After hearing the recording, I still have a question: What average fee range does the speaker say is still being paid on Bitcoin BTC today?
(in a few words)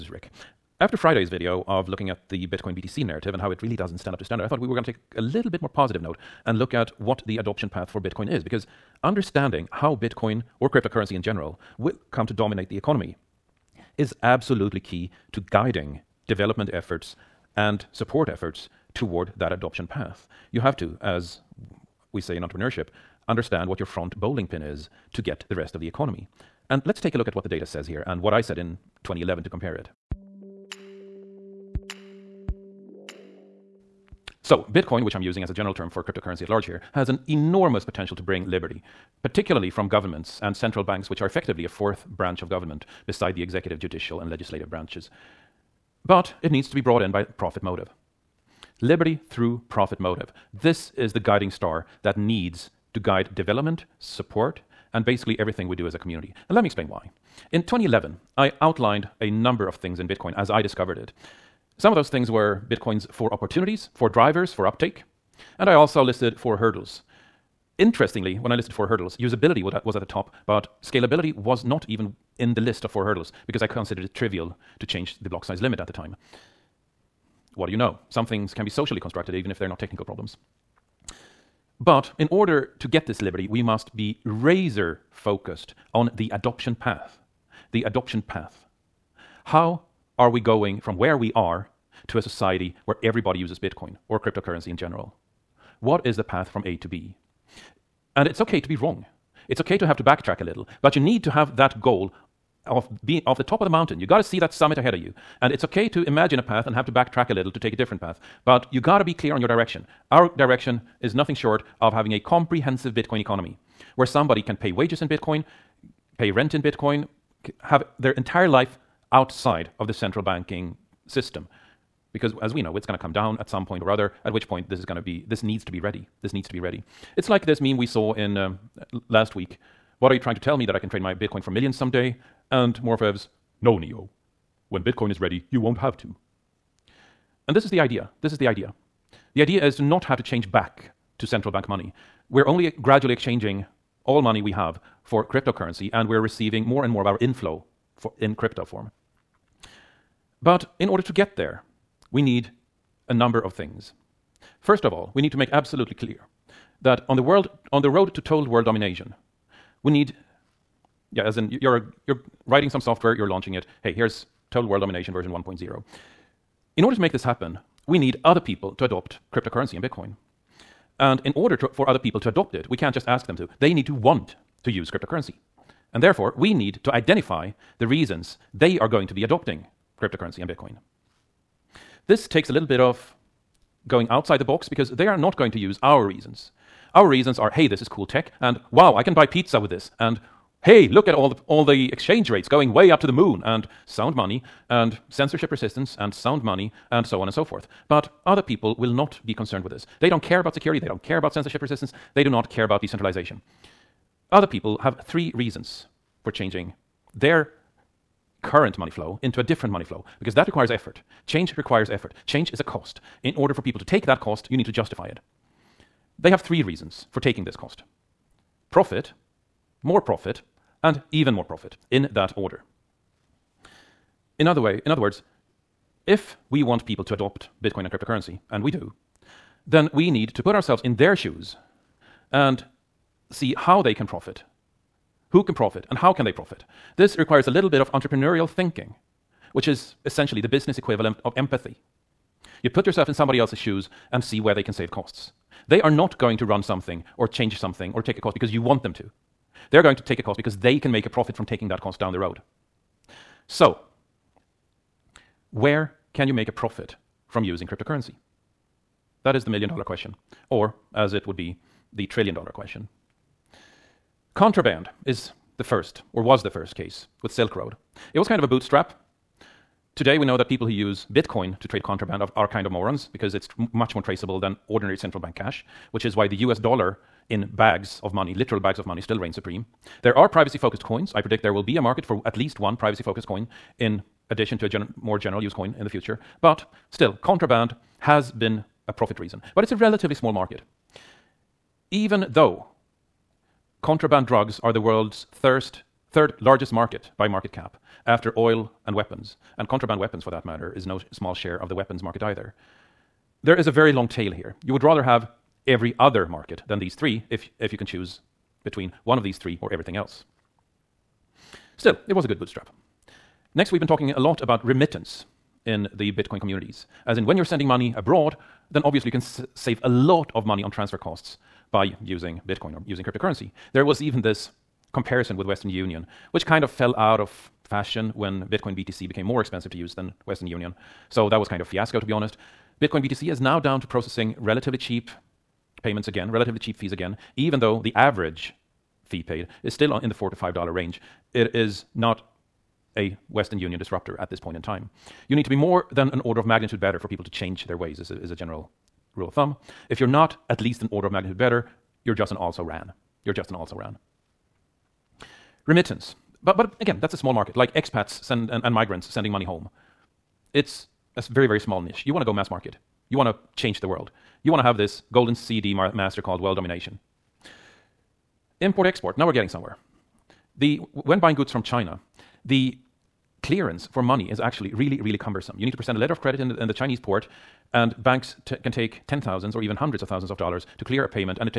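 $4 to $5.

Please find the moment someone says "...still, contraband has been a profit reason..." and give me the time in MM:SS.
04:46.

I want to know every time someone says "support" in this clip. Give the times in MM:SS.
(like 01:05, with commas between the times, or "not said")
00:17, 00:54.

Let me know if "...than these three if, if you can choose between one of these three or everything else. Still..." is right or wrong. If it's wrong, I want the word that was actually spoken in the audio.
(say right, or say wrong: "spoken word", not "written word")
right.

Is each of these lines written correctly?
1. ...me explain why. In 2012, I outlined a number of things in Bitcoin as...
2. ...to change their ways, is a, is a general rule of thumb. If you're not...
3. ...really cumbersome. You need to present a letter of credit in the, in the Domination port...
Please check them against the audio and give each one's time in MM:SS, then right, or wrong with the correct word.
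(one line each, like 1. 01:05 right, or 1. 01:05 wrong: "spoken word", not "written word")
1. 00:56 wrong: "2011", not "2012"
2. 05:47 right
3. 06:15 wrong: "Chinese", not "Domination".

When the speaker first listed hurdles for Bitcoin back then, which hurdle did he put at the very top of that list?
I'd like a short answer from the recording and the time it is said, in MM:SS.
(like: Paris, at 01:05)
Usability, at 01:09.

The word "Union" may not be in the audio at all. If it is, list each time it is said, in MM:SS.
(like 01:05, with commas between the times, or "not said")
05:25, 05:30, 05:43.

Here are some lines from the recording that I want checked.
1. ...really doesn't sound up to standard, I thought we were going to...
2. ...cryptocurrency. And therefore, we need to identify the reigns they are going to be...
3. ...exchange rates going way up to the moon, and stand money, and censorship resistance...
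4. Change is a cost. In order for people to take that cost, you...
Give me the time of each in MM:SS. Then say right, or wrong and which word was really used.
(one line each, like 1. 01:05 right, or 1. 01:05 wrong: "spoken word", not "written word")
1. 00:03 wrong: "stand", not "sound"
2. 02:54 wrong: "reasons", not "reigns"
3. 03:11 wrong: "sound", not "stand"
4. 03:32 right.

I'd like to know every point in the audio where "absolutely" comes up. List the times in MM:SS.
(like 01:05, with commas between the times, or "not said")
00:14, 02:35.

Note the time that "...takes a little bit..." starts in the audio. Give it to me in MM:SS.
03:02.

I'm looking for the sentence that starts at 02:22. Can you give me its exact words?
We're only gradually exchanging all money we have for cryptocurrency, and we're receiving more and more of our inflow in crypto form.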